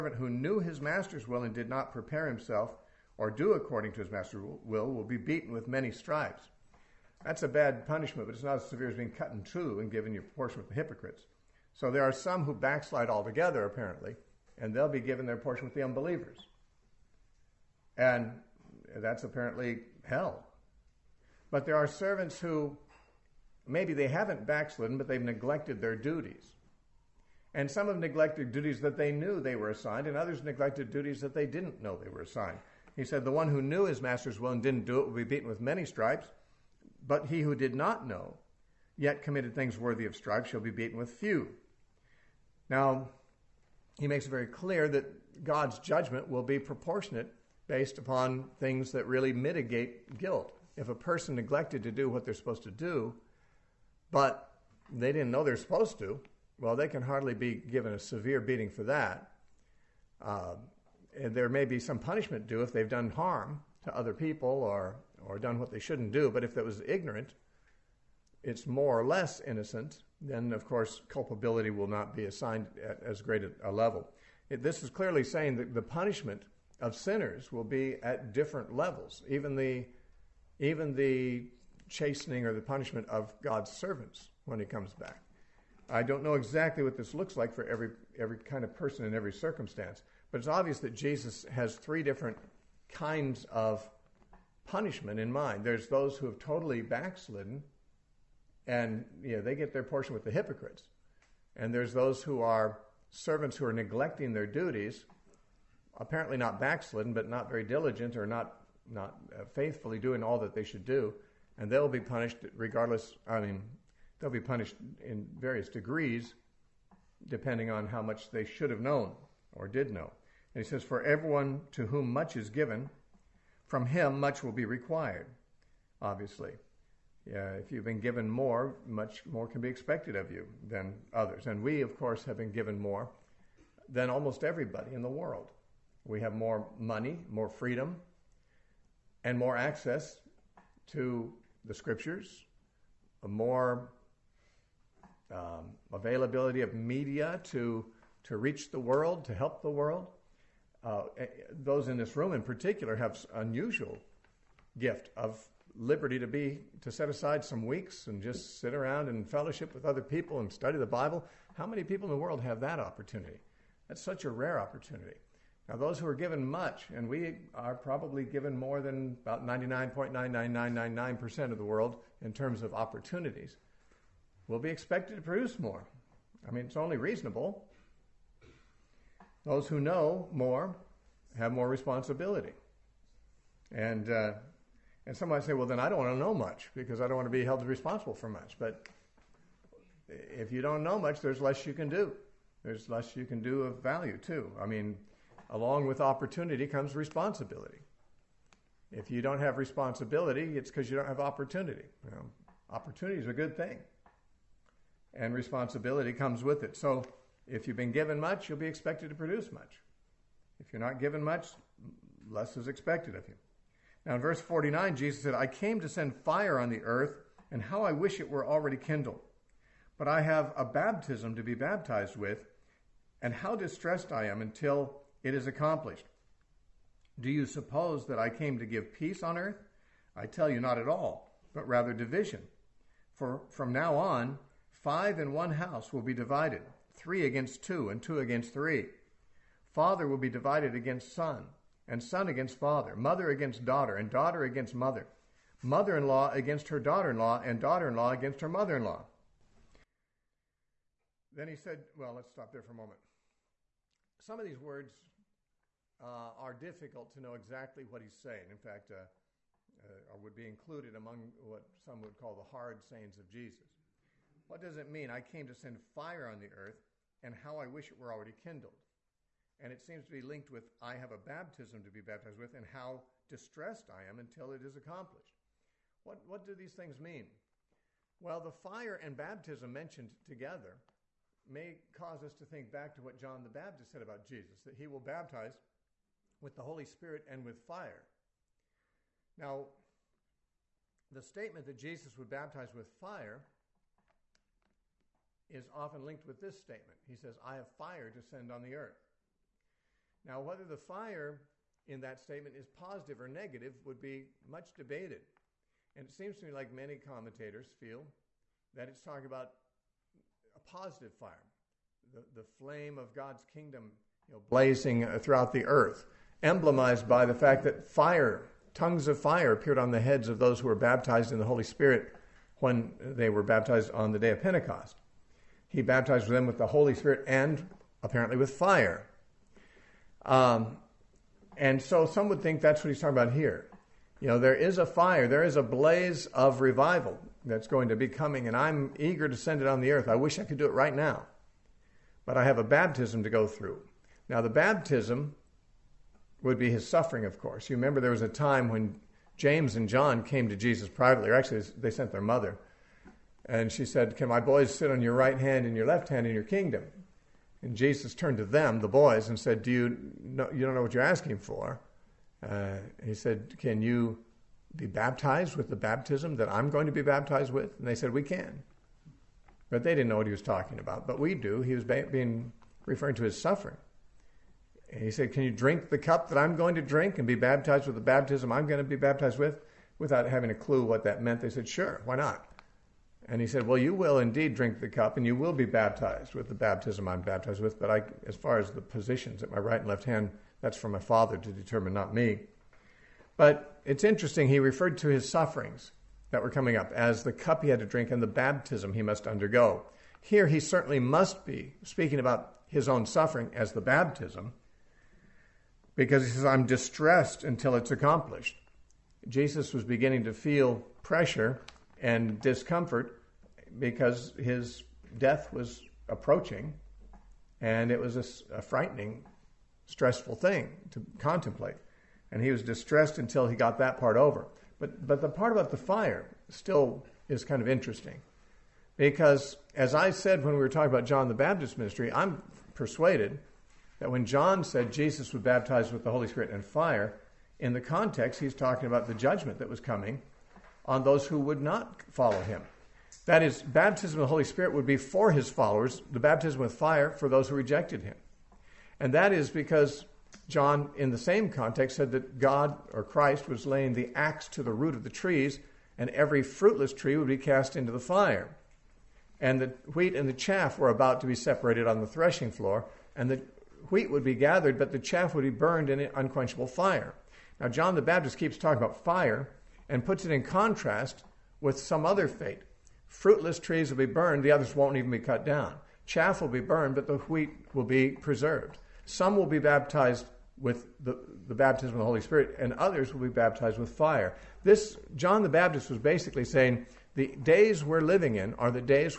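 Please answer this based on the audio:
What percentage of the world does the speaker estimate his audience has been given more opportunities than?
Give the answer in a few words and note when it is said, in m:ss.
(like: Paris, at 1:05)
99.99999%, at 2:49.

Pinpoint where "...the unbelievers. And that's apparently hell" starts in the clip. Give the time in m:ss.
0:15.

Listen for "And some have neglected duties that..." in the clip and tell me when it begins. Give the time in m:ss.
0:27.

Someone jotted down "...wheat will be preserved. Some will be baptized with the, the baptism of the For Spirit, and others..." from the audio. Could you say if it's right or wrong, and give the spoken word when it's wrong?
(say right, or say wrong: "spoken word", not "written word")
wrong: "Holy", not "For".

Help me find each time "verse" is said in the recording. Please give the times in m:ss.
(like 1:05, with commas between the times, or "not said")
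3:34.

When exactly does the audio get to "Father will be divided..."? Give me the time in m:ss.
3:59.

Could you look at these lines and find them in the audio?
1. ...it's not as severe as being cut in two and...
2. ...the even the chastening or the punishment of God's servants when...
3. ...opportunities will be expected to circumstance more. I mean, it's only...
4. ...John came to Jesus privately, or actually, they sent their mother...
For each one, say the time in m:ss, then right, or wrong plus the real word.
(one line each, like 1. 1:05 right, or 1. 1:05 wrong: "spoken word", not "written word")
1. 0:08 right
2. 1:19 right
3. 2:52 wrong: "produce", not "circumstance"
4. 5:49 right.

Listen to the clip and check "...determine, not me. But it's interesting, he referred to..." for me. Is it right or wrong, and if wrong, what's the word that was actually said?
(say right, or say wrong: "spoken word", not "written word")
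right.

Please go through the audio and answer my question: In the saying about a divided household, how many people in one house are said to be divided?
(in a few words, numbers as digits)
5.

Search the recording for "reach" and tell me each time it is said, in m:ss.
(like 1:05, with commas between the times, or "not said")
2:28.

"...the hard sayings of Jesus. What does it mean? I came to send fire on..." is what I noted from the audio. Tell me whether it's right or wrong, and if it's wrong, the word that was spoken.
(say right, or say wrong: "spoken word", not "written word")
right.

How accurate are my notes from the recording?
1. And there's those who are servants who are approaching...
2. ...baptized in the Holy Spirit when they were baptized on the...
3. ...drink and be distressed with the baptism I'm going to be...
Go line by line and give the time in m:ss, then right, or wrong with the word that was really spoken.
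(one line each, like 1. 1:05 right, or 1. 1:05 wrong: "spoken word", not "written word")
1. 1:41 wrong: "neglecting", not "approaching"
2. 5:20 right
3. 6:16 wrong: "baptized", not "distressed".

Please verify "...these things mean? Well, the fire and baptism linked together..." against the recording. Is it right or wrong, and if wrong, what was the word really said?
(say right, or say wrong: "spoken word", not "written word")
wrong: "mentioned", not "linked".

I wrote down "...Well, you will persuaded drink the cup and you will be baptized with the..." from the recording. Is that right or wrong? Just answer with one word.
wrong.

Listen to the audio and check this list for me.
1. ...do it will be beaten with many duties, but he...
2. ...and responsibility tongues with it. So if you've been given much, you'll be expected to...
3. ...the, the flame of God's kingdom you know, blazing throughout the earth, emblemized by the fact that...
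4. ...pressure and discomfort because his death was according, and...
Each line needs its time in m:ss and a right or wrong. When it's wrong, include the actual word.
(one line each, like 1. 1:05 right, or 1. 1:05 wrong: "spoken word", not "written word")
1. 0:34 wrong: "stripes", not "duties"
2. 3:25 wrong: "comes", not "tongues"
3. 5:12 right
4. 6:51 wrong: "approaching", not "according".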